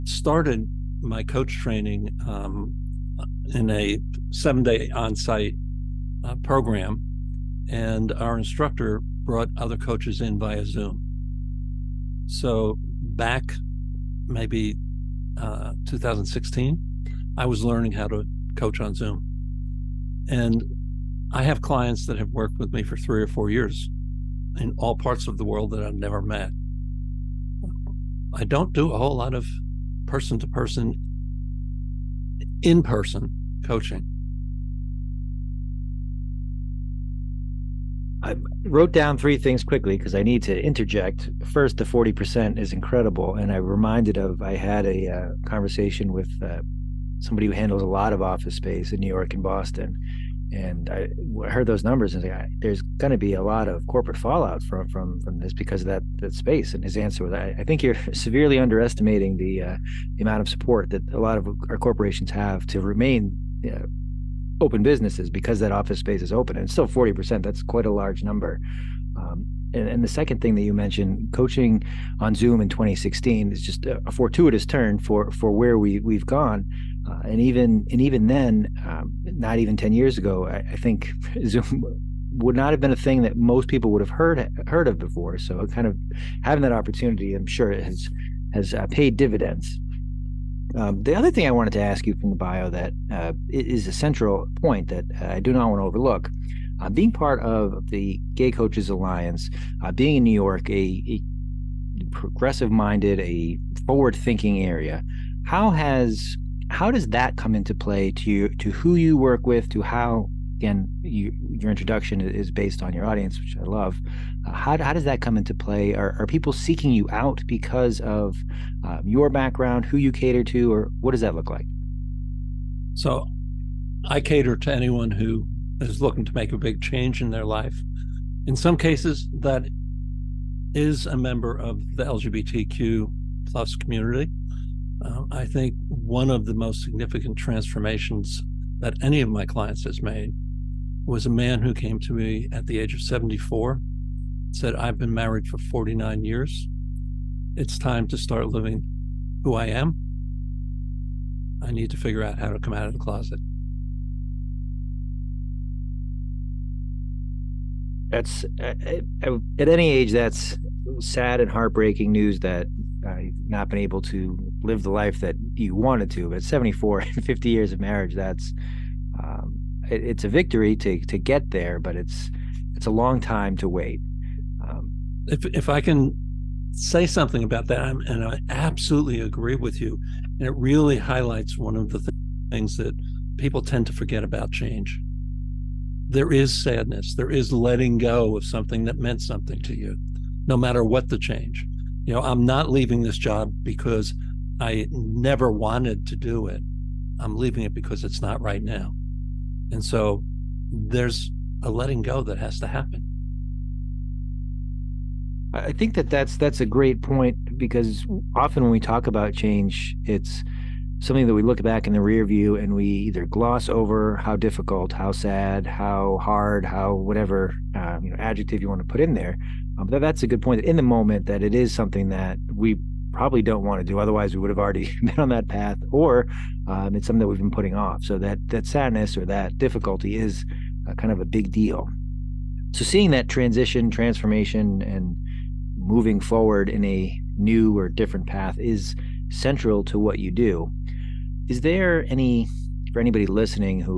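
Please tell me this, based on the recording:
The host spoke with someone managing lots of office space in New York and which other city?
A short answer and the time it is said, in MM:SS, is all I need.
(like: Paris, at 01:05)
Boston, at 00:49.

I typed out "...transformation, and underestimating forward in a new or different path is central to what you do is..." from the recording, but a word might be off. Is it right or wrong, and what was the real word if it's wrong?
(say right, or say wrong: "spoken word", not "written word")
wrong: "moving", not "underestimating".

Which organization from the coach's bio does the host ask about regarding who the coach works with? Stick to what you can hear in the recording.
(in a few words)
Gay Coaches Alliance.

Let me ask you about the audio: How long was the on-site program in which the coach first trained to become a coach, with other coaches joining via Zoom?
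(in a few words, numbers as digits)
7 days.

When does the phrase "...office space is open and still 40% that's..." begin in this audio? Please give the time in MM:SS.
01:05.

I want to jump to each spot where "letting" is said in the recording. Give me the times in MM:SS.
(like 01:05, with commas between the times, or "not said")
03:07, 03:21.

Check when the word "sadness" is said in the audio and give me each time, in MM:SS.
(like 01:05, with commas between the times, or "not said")
03:06, 03:48.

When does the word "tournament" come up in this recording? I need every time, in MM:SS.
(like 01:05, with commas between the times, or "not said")
not said.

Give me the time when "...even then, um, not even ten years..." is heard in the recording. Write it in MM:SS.
01:18.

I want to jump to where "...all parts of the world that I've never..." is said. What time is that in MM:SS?
00:24.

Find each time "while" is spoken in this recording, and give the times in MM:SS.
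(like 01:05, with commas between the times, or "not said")
not said.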